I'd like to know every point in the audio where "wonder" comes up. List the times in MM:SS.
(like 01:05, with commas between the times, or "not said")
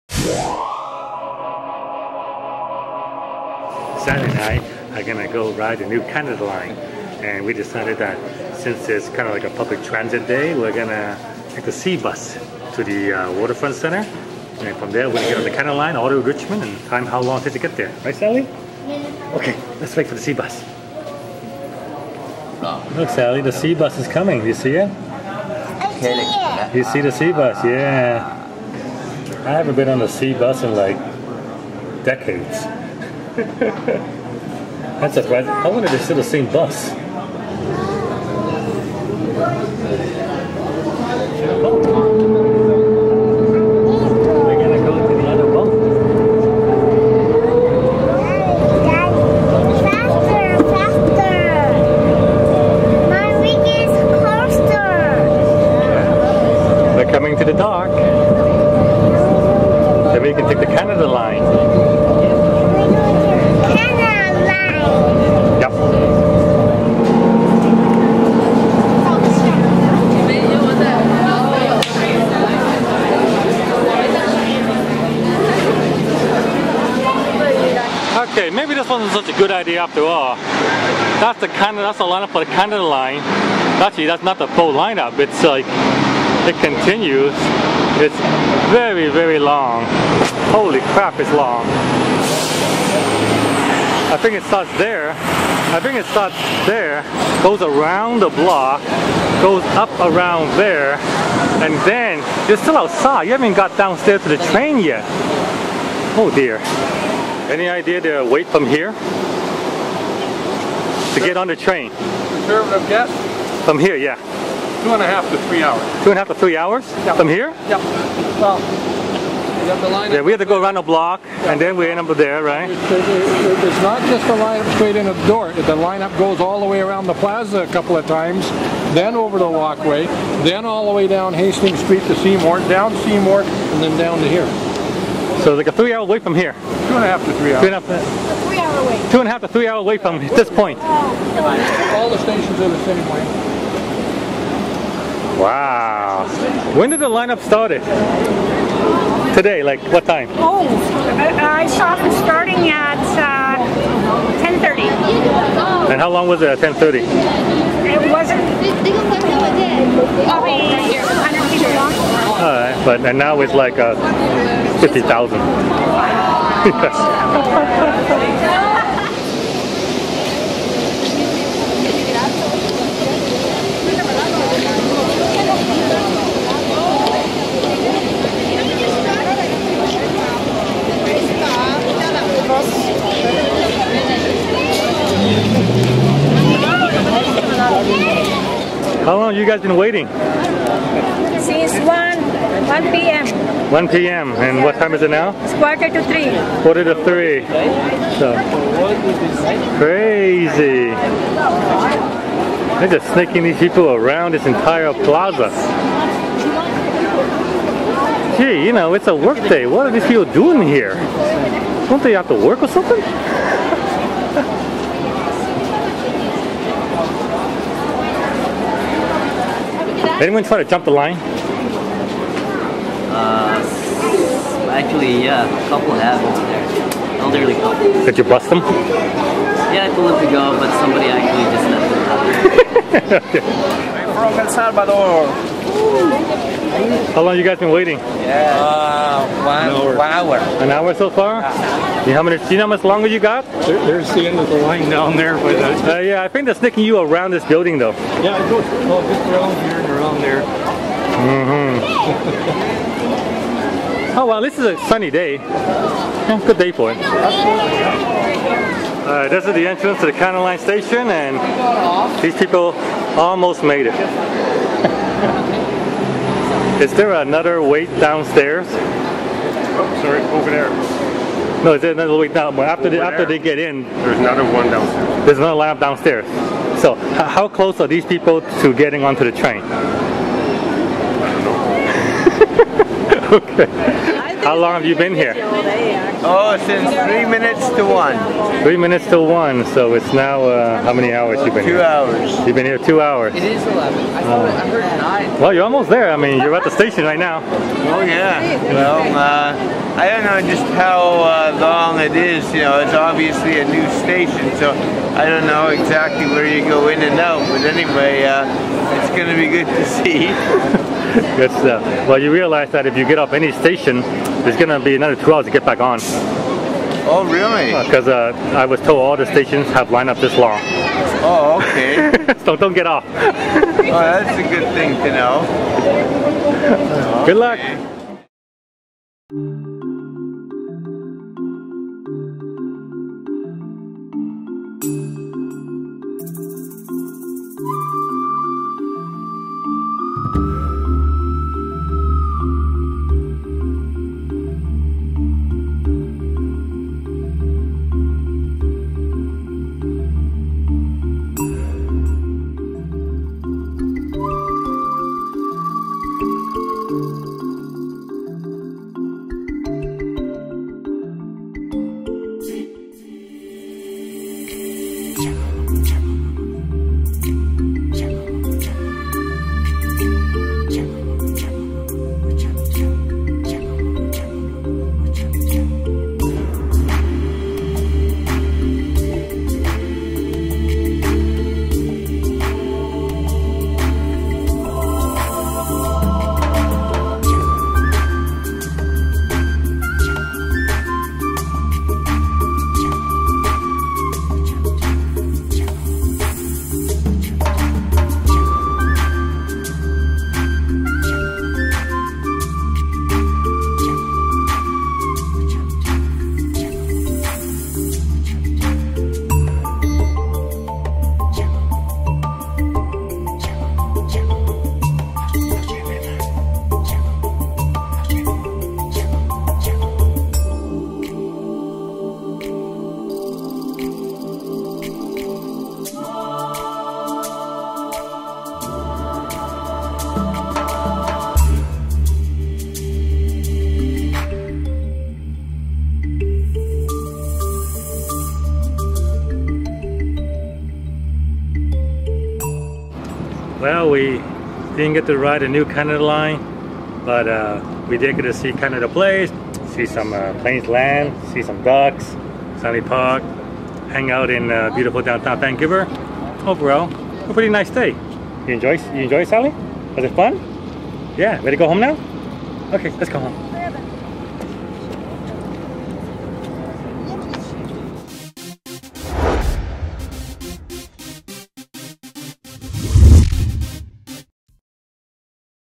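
not said.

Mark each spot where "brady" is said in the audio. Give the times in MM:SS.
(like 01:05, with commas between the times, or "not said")
not said.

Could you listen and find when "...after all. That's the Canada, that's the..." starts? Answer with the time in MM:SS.
01:19.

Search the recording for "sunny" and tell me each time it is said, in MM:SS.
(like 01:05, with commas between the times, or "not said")
04:14, 07:32.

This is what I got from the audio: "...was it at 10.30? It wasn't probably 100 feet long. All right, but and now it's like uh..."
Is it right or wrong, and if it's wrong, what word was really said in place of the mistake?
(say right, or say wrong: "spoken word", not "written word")
right.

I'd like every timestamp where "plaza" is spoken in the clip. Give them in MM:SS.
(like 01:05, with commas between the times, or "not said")
02:07, 03:24.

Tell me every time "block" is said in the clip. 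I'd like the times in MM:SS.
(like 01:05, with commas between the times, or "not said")
01:38, 02:00.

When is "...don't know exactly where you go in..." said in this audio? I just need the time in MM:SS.
05:05.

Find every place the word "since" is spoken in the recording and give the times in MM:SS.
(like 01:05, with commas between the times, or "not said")
00:08, 03:11, 04:46.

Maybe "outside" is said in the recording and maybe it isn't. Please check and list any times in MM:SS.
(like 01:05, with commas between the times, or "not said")
01:42.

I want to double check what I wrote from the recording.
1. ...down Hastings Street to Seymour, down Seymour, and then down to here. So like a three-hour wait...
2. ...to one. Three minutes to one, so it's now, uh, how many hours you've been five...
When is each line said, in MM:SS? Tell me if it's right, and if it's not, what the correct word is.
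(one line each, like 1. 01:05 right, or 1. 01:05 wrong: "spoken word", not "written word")
1. 02:11 right
2. 04:47 wrong: "two", not "five".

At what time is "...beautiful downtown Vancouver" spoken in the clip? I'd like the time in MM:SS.
07:34.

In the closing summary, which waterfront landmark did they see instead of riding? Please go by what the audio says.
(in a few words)
Canada Place.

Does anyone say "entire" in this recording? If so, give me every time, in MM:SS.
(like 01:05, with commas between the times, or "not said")
03:24.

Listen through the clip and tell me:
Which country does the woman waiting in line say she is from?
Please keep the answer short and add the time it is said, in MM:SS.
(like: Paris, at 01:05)
El Salvador, at 03:54.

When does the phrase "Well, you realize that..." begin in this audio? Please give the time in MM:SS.
05:12.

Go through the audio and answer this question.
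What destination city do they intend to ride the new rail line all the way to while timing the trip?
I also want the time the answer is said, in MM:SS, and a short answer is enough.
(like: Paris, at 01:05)
Richmond, at 00:16.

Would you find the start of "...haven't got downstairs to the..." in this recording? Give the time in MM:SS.
01:43.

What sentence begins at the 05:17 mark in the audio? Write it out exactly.
Because uh, uh, I was told all the stations have up this long.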